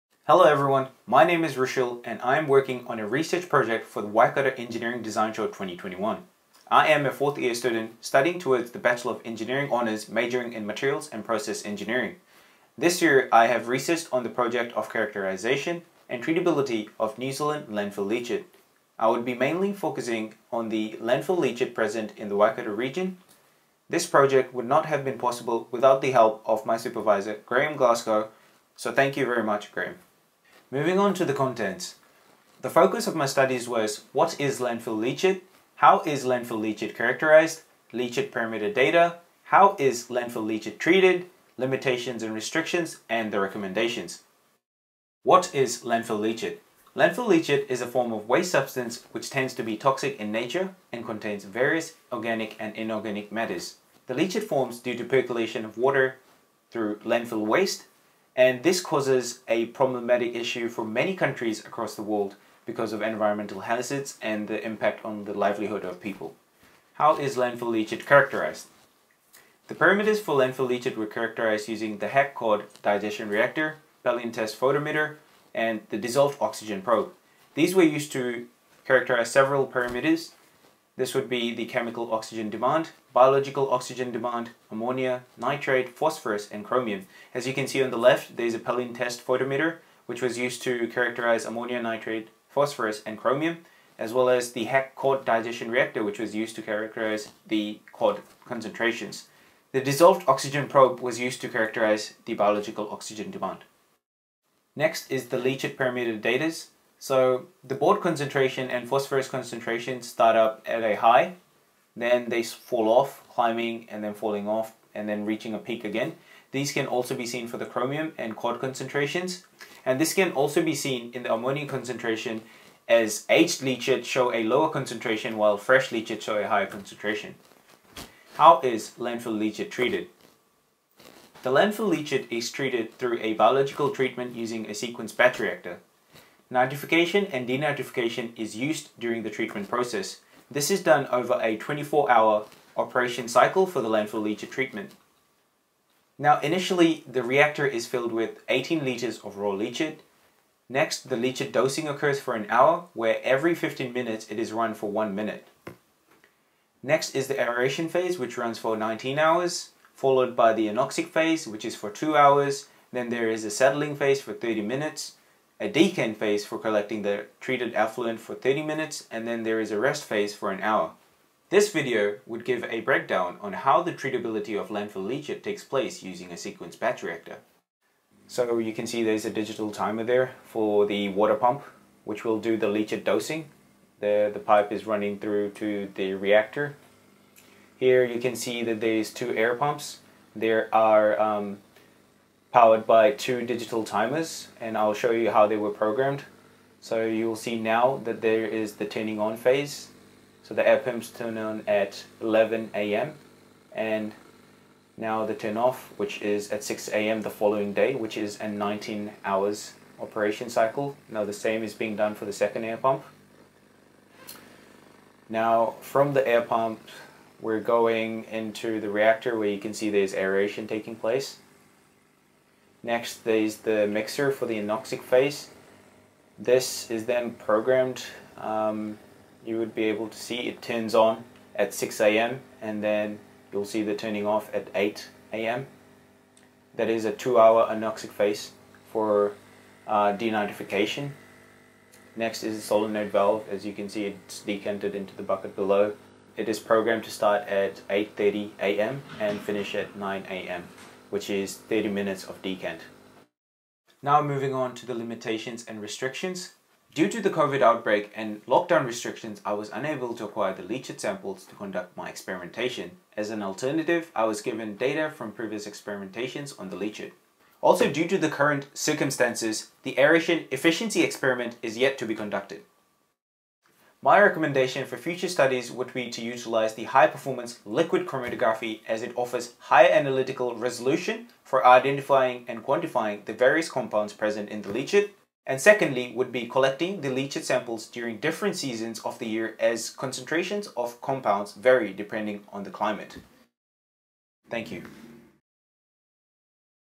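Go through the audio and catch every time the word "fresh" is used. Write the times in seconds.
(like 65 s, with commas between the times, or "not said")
125 s.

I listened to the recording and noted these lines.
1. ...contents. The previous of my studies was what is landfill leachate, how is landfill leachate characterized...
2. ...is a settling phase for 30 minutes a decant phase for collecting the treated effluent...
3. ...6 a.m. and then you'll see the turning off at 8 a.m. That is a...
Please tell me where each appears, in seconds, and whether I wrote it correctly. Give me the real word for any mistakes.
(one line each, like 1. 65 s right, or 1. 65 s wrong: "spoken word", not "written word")
1. 31 s wrong: "focus", not "previous"
2. 163 s right
3. 231 s right.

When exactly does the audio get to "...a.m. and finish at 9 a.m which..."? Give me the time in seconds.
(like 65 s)
248 s.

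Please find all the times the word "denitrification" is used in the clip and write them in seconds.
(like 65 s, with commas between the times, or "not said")
137 s, 240 s.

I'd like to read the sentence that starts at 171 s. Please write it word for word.
This video would give a breakdown on how the treatability of landfill leachate takes place using a sequence batch reactor.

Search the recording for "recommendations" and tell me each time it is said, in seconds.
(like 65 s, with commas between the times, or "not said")
43 s, 274 s.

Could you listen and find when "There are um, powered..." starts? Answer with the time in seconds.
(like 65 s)
190 s.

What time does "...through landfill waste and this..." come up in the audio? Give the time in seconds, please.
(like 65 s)
56 s.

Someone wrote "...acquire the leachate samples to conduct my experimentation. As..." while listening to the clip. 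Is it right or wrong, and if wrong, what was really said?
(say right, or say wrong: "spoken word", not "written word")
right.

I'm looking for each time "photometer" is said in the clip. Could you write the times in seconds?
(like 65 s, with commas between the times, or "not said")
74 s, 89 s.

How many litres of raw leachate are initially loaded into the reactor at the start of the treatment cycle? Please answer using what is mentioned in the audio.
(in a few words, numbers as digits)
18 litres.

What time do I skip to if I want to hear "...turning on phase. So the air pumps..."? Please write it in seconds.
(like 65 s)
198 s.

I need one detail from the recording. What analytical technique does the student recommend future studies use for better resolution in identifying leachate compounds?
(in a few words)
High performance liquid chromatography.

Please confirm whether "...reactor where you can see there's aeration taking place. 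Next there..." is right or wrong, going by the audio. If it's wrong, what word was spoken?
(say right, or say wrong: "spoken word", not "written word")
right.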